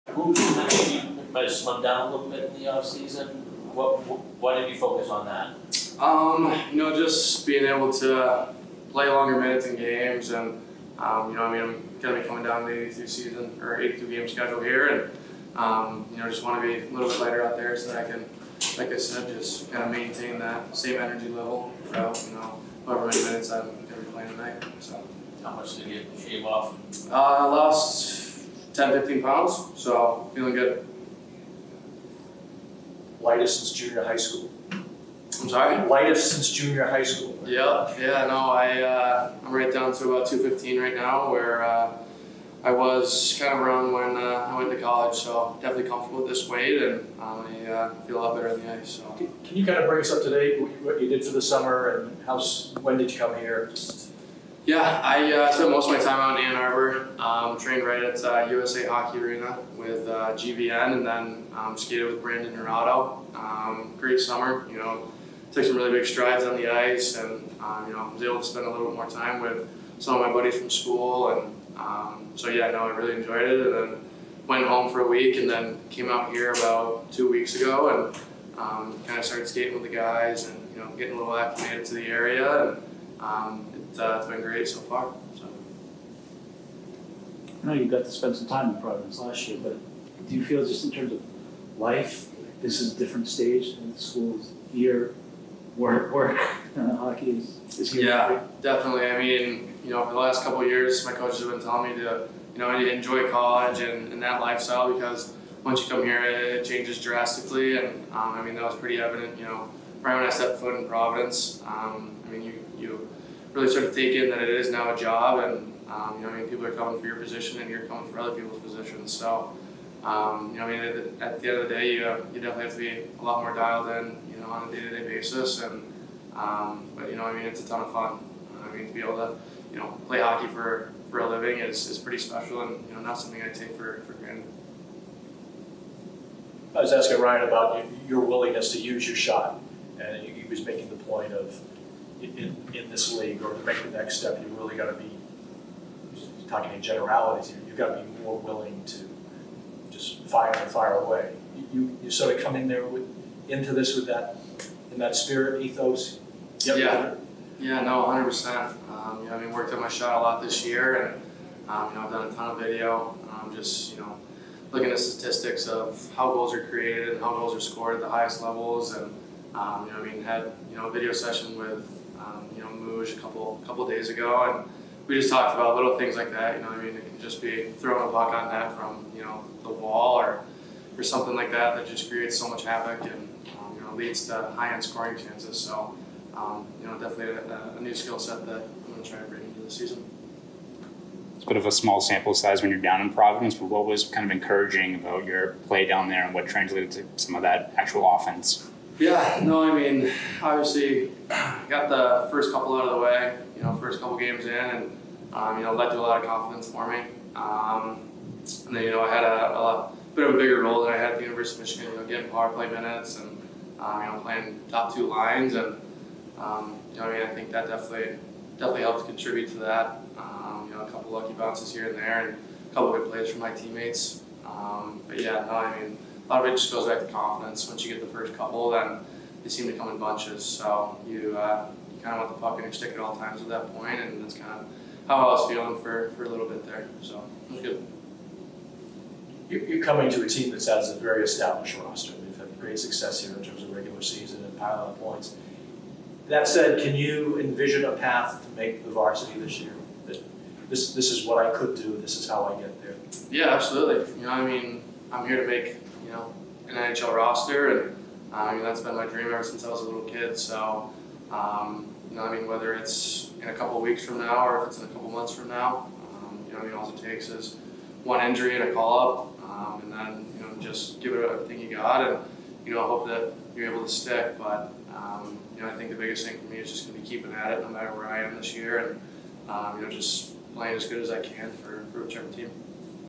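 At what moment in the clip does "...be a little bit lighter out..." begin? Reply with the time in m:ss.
0:16.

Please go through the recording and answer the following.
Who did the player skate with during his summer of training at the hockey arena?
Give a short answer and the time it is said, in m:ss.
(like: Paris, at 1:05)
Brandon Naurato, at 1:02.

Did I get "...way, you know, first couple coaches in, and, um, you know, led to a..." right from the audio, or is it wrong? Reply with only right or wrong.
wrong.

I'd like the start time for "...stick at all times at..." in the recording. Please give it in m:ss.
3:52.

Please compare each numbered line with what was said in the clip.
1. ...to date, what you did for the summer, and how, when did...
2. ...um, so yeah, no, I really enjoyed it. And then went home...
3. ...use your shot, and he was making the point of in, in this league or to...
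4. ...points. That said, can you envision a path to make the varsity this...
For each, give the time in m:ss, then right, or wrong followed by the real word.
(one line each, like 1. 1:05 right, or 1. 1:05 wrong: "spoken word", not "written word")
1. 0:50 right
2. 1:11 right
3. 2:18 right
4. 4:05 right.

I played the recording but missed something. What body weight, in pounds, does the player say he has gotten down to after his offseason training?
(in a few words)
215.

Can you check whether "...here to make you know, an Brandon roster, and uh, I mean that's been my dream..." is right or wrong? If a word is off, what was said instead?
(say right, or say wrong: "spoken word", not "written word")
wrong: "NHL", not "Brandon".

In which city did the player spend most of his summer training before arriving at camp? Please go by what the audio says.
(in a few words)
Ann Arbor.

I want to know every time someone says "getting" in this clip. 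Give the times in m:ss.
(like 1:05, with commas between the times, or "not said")
1:20, 3:32.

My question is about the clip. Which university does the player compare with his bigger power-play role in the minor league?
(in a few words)
University of Michigan.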